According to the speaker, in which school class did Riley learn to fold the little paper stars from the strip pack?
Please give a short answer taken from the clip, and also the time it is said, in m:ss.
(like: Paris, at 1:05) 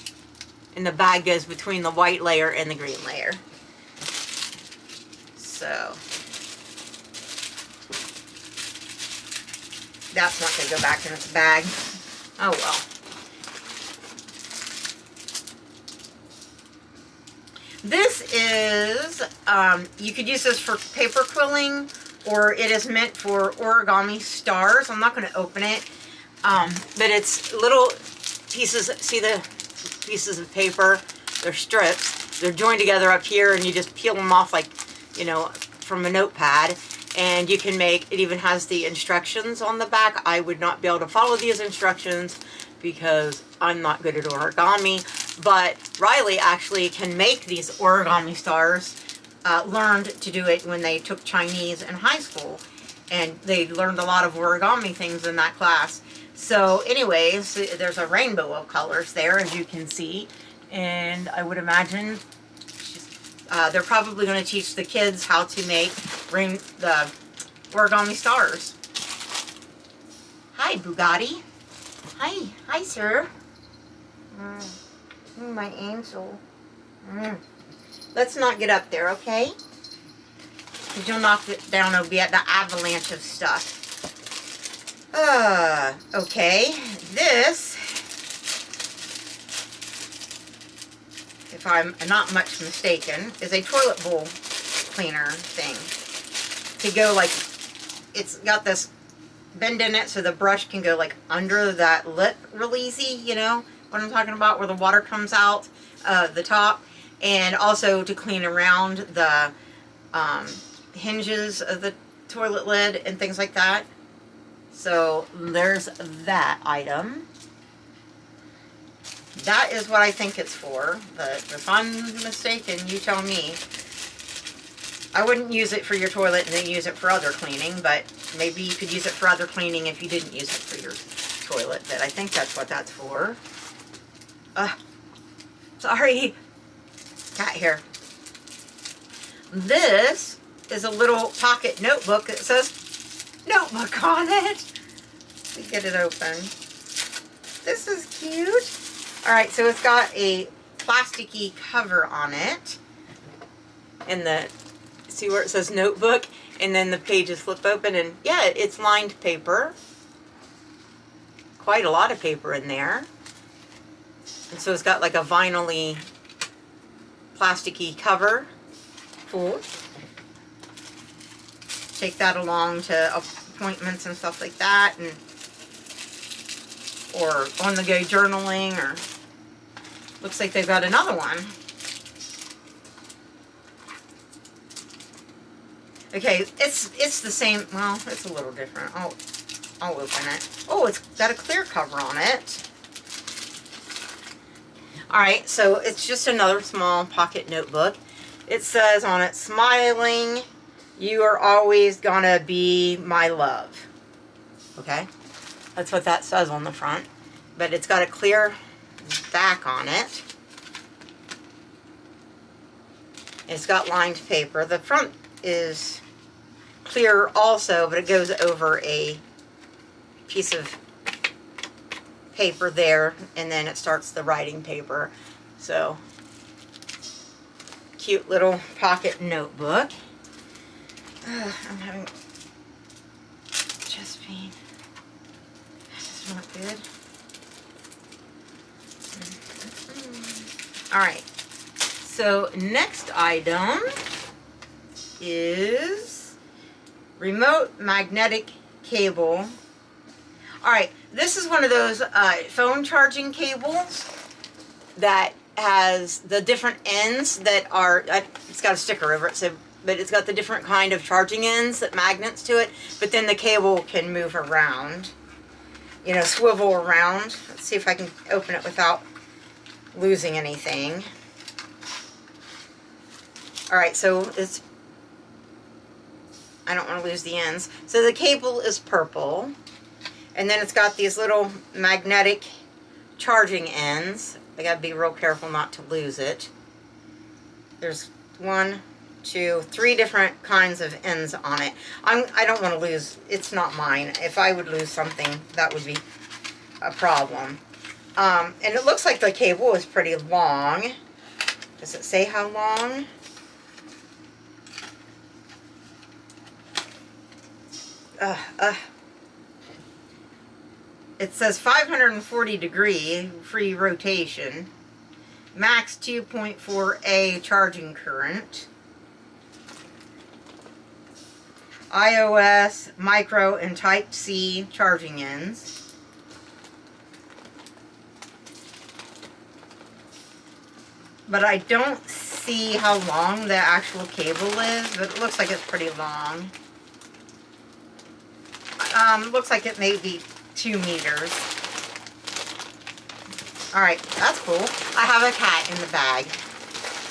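Chinese, at 0:51.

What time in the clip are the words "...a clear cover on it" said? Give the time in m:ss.
3:11.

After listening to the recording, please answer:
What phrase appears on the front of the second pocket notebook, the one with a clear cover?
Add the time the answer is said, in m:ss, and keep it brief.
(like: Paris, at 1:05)
You are always going to be my love, at 3:21.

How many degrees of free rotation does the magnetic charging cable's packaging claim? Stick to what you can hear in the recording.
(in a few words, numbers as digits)
540.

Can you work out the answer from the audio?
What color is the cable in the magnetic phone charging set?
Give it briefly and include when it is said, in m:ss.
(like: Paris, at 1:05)
Purple, at 4:38.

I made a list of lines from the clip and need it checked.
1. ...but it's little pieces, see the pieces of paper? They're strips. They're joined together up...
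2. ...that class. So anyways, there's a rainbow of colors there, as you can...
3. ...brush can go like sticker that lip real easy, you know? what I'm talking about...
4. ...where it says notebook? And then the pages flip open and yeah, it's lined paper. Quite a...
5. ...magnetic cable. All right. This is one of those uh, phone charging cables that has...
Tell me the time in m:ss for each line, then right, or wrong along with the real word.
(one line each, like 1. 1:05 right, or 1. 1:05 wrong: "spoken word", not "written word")
1. 0:26 right
2. 0:55 right
3. 1:40 wrong: "under", not "sticker"
4. 2:35 right
5. 4:07 right.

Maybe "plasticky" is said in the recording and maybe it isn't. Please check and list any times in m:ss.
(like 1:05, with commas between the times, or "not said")
2:30, 2:47.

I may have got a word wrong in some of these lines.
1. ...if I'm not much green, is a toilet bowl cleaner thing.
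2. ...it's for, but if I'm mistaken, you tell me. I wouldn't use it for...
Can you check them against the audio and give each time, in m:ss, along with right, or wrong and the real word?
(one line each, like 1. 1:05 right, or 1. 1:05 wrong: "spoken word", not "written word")
1. 1:31 wrong: "mistaken", not "green"
2. 2:00 right.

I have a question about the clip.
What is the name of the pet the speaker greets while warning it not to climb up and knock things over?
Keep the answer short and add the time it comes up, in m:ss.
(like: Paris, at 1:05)
Bugatti, at 1:10.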